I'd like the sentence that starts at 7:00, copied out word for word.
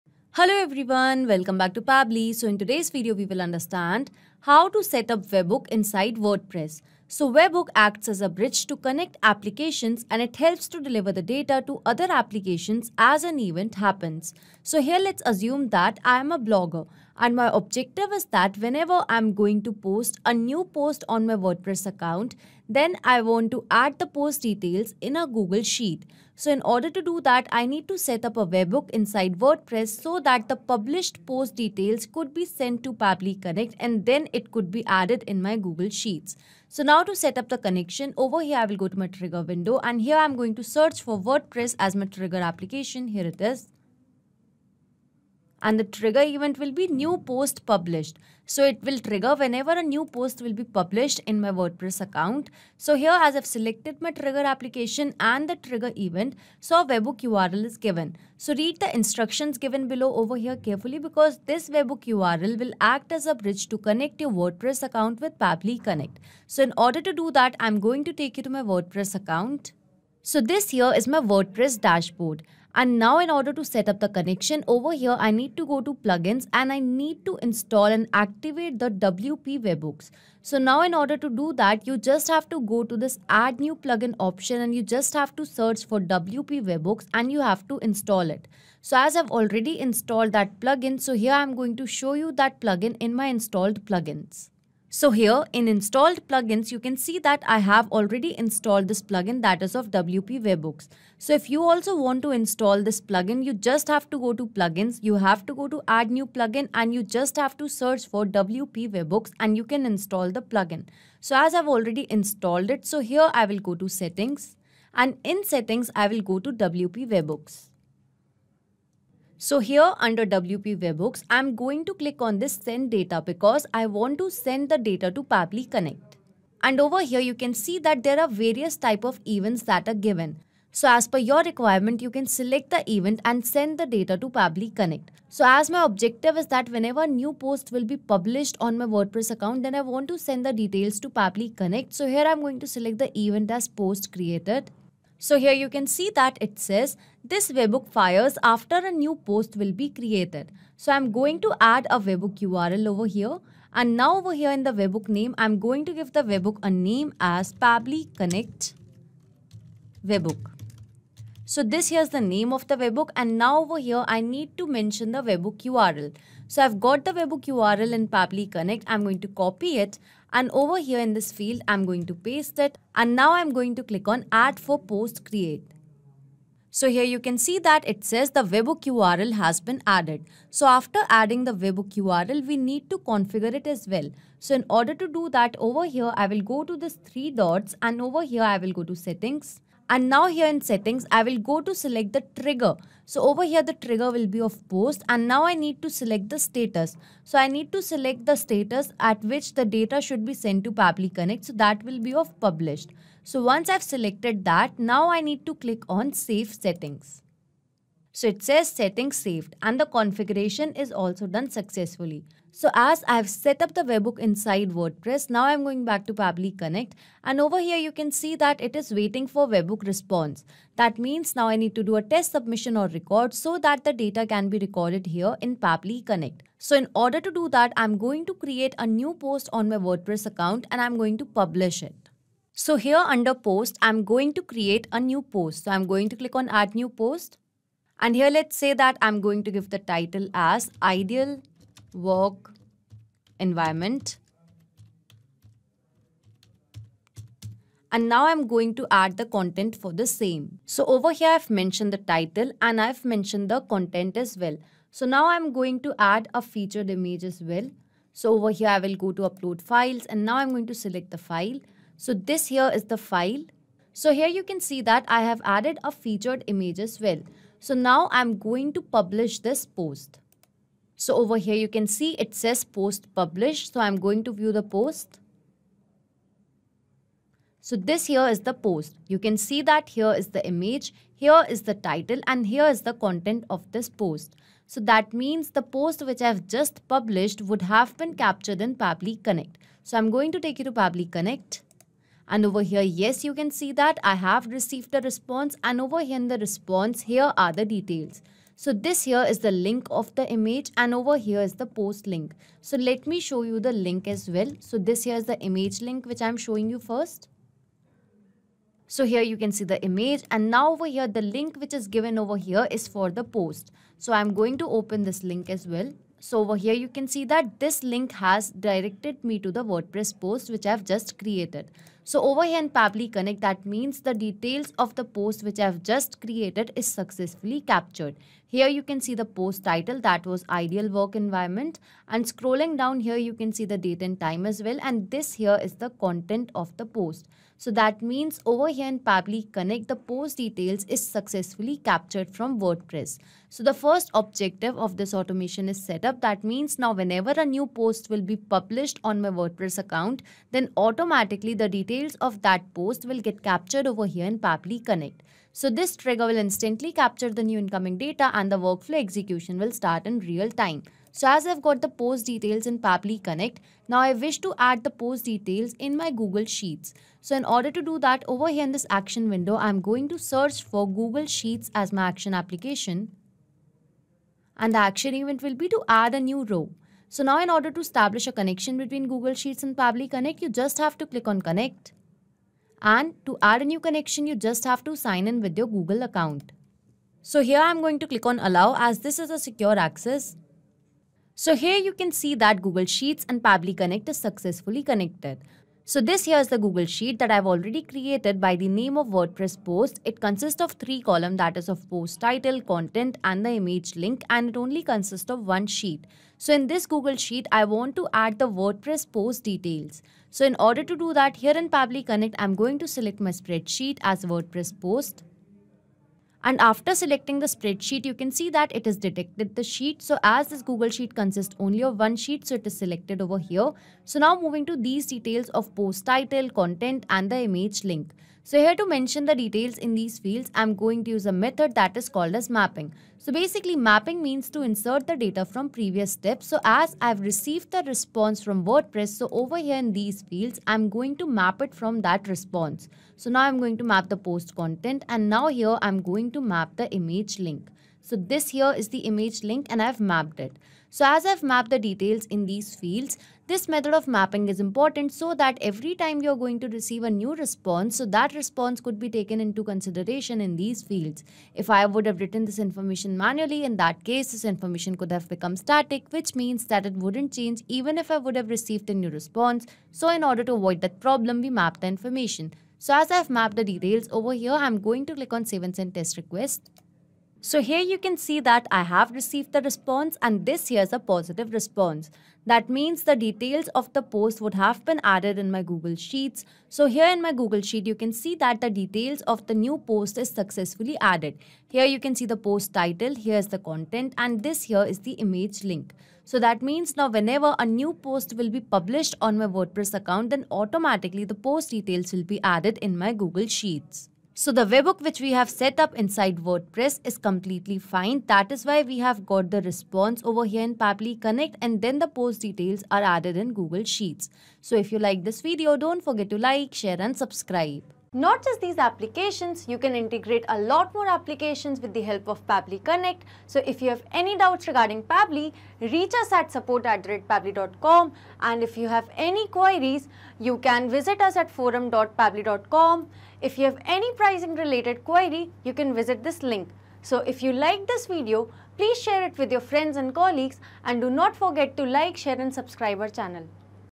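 So as this Google Sheet consists only of one sheet, so it is selected over here.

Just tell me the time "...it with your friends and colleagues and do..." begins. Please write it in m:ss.
8:59.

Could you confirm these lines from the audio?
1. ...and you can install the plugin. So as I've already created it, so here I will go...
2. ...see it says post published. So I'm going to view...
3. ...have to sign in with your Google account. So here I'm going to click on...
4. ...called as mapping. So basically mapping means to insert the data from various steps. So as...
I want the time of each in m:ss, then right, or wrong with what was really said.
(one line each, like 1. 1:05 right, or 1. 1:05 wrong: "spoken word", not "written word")
1. 1:49 wrong: "installed", not "created"
2. 4:31 right
3. 6:24 right
4. 7:12 wrong: "previous", not "various".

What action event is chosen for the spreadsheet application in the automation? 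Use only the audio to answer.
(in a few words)
add a new row.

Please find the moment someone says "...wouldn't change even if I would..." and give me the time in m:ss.
7:46.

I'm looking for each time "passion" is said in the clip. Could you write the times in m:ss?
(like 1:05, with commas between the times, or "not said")
not said.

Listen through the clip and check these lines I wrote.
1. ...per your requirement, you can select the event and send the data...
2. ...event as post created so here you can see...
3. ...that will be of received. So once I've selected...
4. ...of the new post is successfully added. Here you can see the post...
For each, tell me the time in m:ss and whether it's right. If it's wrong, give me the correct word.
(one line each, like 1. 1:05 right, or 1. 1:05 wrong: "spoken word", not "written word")
1. 2:11 right
2. 2:23 right
3. 3:21 wrong: "published", not "received"
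4. 8:09 right.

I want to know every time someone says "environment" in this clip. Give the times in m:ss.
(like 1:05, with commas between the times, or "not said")
4:03, 5:31.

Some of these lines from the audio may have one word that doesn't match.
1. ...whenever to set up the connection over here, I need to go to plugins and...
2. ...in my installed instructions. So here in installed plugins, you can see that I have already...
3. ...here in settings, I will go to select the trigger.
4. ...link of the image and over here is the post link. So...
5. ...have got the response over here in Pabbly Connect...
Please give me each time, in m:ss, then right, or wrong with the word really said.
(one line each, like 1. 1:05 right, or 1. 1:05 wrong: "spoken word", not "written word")
1. 1:13 wrong: "order", not "whenever"
2. 1:32 wrong: "plugins", not "instructions"
3. 3:10 right
4. 4:59 right
5. 8:28 right.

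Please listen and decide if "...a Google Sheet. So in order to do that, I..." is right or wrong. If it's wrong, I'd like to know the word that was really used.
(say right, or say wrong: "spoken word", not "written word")
right.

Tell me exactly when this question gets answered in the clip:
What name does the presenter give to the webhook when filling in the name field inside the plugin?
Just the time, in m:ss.
2:37.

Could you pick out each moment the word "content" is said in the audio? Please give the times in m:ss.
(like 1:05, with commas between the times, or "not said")
4:09, 4:13, 4:42, 5:36, 6:42, 7:06, 7:24, 8:13.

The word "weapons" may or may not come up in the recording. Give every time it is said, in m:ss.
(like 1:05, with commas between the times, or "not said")
not said.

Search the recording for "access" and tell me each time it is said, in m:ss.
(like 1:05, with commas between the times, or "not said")
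6:29.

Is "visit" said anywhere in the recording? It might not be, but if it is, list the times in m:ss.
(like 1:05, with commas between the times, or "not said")
8:50, 8:55.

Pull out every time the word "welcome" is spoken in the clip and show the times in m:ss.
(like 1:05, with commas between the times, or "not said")
0:01.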